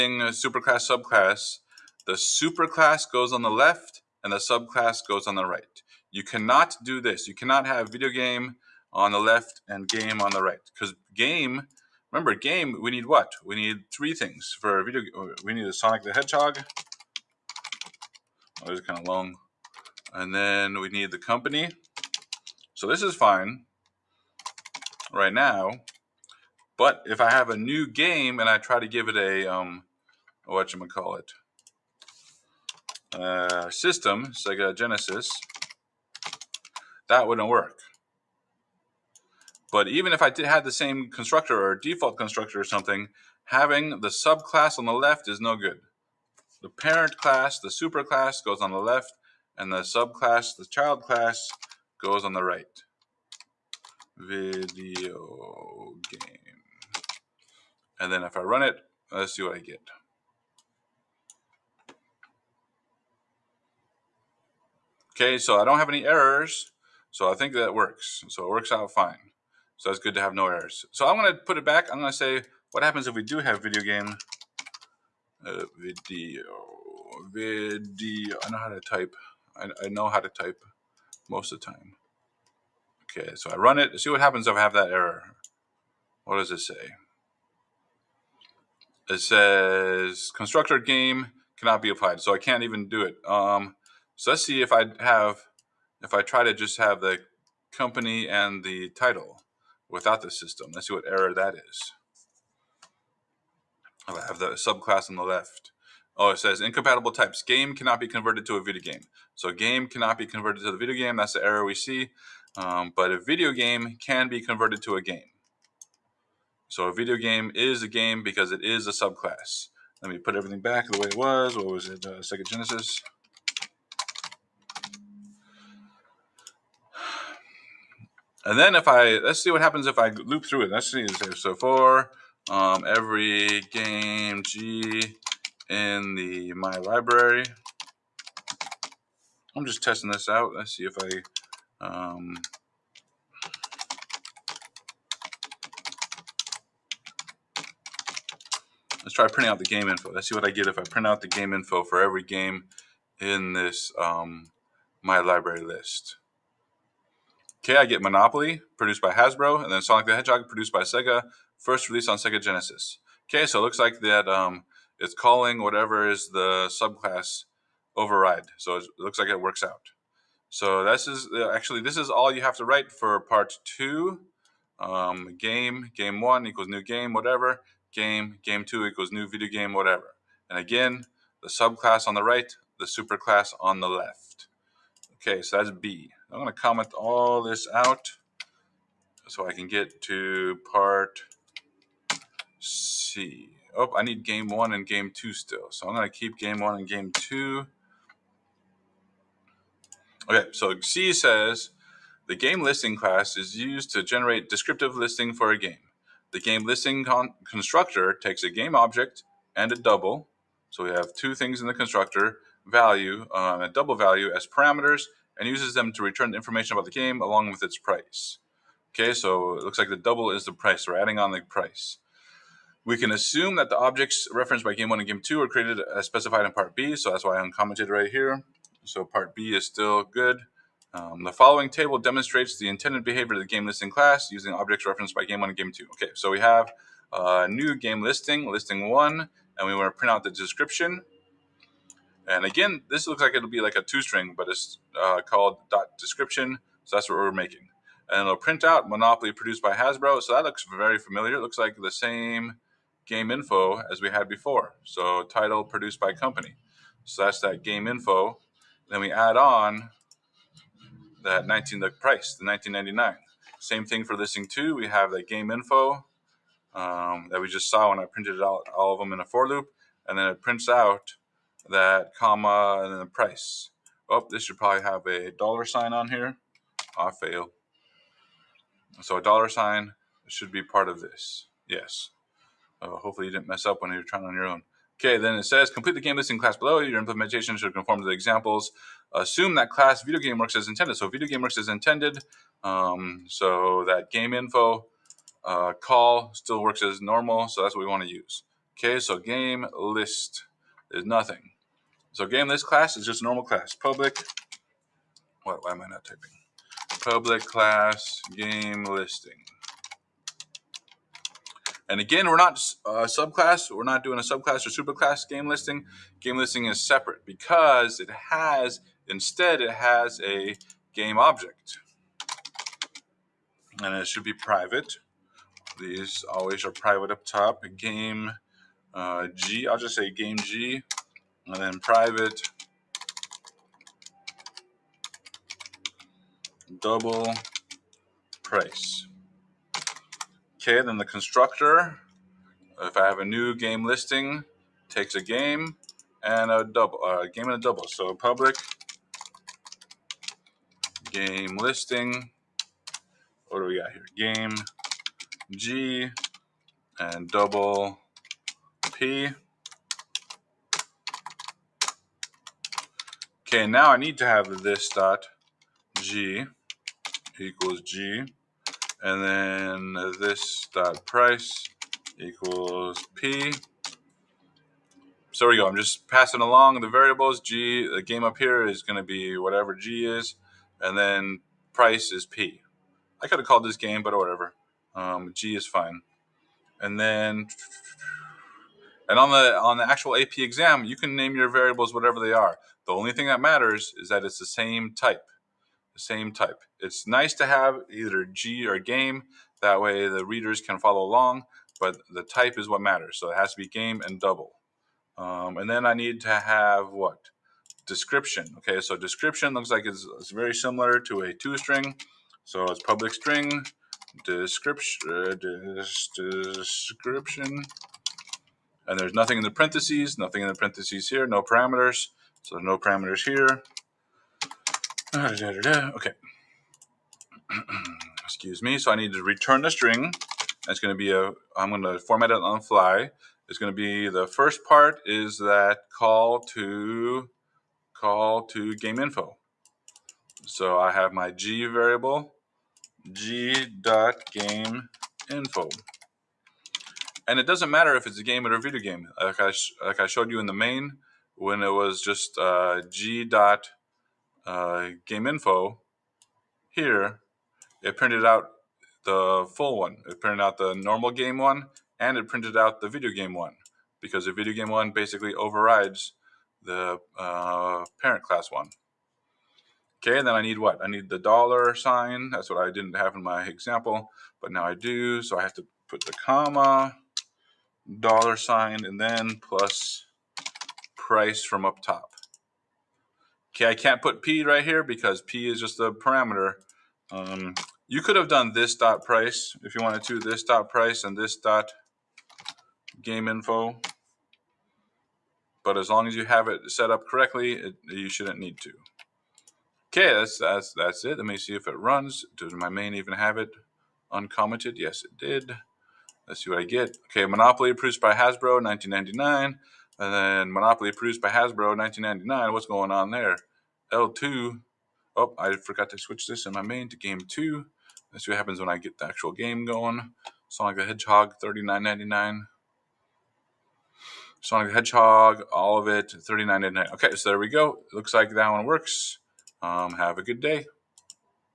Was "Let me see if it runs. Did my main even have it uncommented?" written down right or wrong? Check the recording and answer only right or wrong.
right.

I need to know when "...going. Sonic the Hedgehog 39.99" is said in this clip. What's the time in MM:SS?
08:39.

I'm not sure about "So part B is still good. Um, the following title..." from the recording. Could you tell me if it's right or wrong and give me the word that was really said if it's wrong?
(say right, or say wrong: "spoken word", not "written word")
wrong: "table", not "title".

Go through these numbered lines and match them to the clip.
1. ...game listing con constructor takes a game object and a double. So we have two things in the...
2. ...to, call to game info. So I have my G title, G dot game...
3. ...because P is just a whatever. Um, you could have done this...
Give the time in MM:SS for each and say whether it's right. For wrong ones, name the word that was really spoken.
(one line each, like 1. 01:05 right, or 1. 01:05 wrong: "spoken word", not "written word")
1. 03:26 right
2. 07:16 wrong: "variable", not "title"
3. 08:04 wrong: "parameter", not "whatever".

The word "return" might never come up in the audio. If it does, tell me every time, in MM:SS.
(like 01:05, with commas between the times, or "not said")
03:36, 07:09.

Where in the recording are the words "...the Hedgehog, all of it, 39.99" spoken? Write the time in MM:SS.
08:44.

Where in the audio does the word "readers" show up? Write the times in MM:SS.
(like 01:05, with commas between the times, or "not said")
06:40.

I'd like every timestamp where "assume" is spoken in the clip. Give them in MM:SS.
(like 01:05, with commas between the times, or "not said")
03:43, 04:49.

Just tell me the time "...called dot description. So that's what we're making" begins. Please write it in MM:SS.
04:05.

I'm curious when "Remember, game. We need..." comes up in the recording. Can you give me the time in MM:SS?
00:12.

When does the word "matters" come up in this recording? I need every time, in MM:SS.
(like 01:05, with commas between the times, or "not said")
06:33, 06:42, 07:27.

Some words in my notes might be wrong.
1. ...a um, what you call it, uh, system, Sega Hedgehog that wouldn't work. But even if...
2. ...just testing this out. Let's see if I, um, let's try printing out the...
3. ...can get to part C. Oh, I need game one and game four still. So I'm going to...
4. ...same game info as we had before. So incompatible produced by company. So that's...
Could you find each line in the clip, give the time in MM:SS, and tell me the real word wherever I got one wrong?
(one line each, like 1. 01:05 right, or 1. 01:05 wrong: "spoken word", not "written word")
1. 00:29 wrong: "Genesis", not "Hedgehog"
2. 02:19 right
3. 03:09 wrong: "two", not "four"
4. 04:11 wrong: "title", not "incompatible".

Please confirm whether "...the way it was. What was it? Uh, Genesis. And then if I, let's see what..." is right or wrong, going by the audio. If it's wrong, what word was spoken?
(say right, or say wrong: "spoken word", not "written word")
right.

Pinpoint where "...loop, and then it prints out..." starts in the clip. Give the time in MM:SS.
04:29.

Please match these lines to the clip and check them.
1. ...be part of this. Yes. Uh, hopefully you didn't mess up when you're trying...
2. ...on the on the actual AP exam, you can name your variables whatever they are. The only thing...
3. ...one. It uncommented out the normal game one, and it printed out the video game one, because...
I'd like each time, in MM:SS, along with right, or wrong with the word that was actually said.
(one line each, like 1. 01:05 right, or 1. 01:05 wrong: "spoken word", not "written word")
1. 04:40 right
2. 06:29 right
3. 07:39 wrong: "printed", not "uncommented".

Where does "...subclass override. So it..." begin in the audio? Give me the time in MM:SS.
02:46.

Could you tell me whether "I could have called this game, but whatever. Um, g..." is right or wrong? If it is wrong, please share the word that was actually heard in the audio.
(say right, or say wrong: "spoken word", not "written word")
right.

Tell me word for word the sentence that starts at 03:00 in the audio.
And again, the subclass on the right, the superclass on the left.